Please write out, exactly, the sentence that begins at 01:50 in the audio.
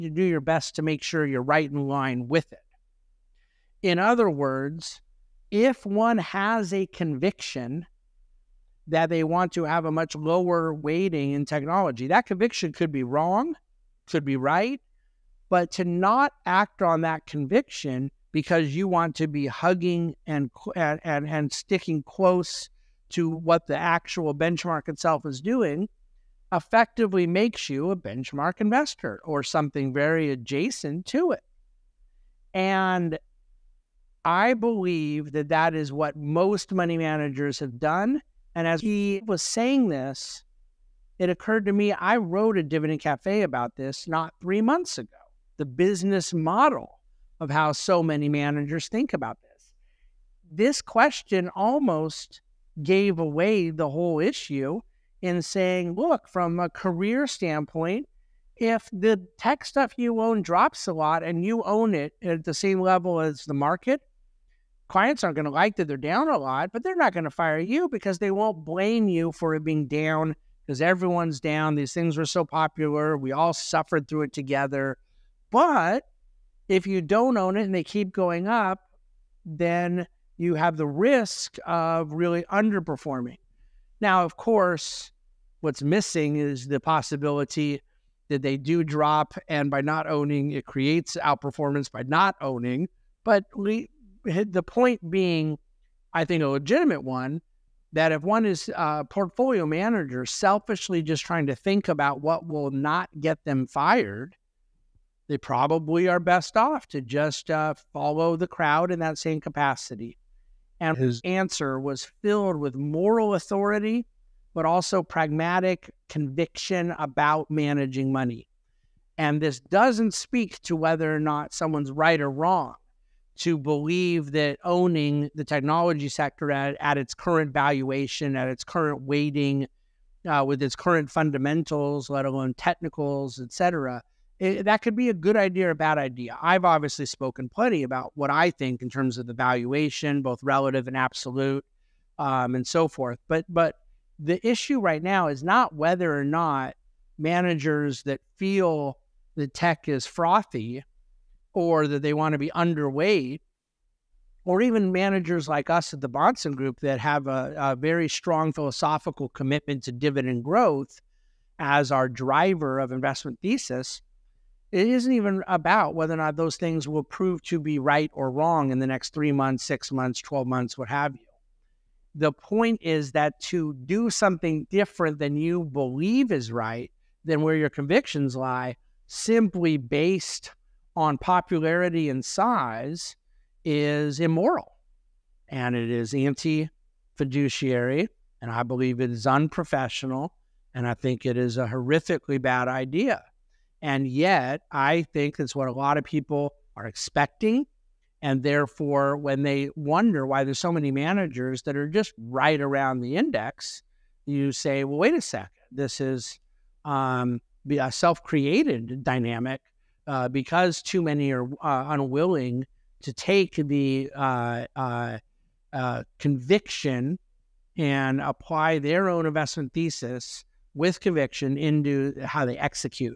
And his answer was filled with moral authority, but also pragmatic conviction about managing money.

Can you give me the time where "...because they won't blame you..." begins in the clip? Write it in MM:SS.
01:07.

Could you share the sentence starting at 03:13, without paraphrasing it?
And yet, I think that's what a lot of people are expecting.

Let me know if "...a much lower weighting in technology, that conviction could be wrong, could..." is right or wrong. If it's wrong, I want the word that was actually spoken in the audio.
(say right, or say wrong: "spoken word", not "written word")
right.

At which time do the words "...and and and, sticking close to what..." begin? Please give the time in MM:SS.
00:20.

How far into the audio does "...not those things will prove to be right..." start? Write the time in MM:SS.
02:46.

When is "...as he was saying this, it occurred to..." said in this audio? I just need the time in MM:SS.
00:38.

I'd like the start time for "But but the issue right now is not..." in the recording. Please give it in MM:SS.
02:23.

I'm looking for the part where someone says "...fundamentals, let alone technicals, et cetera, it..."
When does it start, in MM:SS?
02:11.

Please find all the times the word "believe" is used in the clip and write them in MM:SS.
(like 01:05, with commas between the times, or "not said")
00:34, 02:03, 02:55, 03:08.